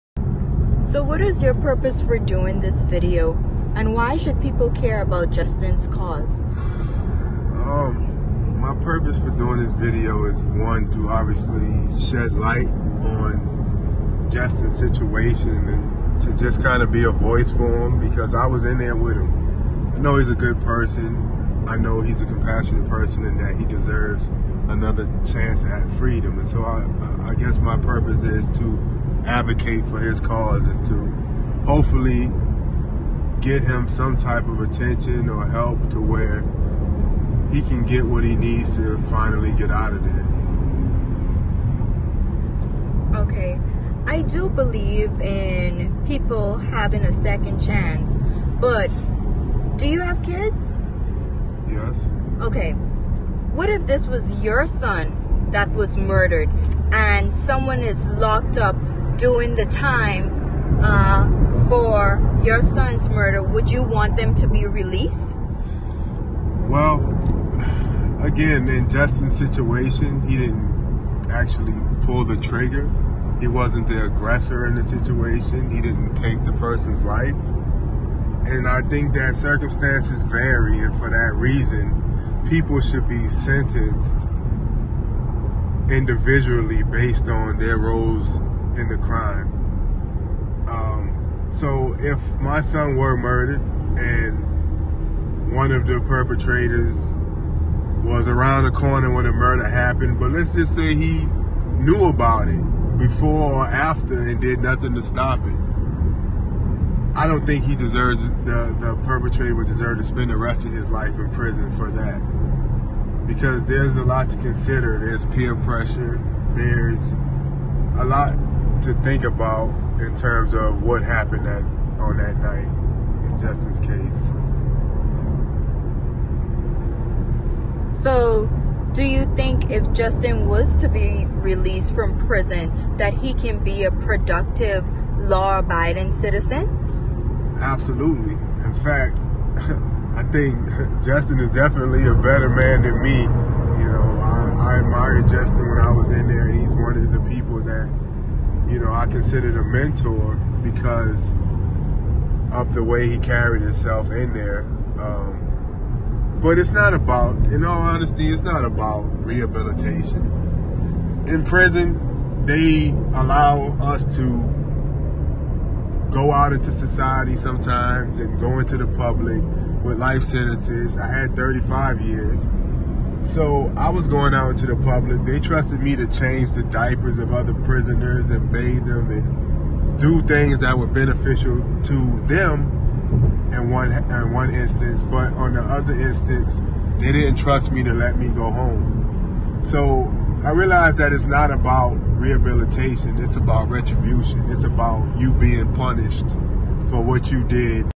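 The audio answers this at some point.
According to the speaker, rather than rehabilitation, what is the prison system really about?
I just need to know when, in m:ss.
3:13.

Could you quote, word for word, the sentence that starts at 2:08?
So, do you think if Justin was to be released from prison that he can be a productive law-abiding citizen?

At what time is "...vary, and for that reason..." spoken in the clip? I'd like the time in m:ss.
1:20.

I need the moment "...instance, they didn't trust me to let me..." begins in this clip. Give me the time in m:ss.
3:05.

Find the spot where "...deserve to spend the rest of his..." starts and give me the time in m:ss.
1:49.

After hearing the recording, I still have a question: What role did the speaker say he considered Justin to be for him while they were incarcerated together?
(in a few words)
A mentor.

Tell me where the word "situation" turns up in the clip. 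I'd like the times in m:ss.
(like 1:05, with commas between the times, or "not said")
0:14, 1:09, 1:14.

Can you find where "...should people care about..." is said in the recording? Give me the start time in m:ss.
0:04.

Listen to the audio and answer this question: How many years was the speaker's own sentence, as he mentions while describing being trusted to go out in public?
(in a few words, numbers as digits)
35 years.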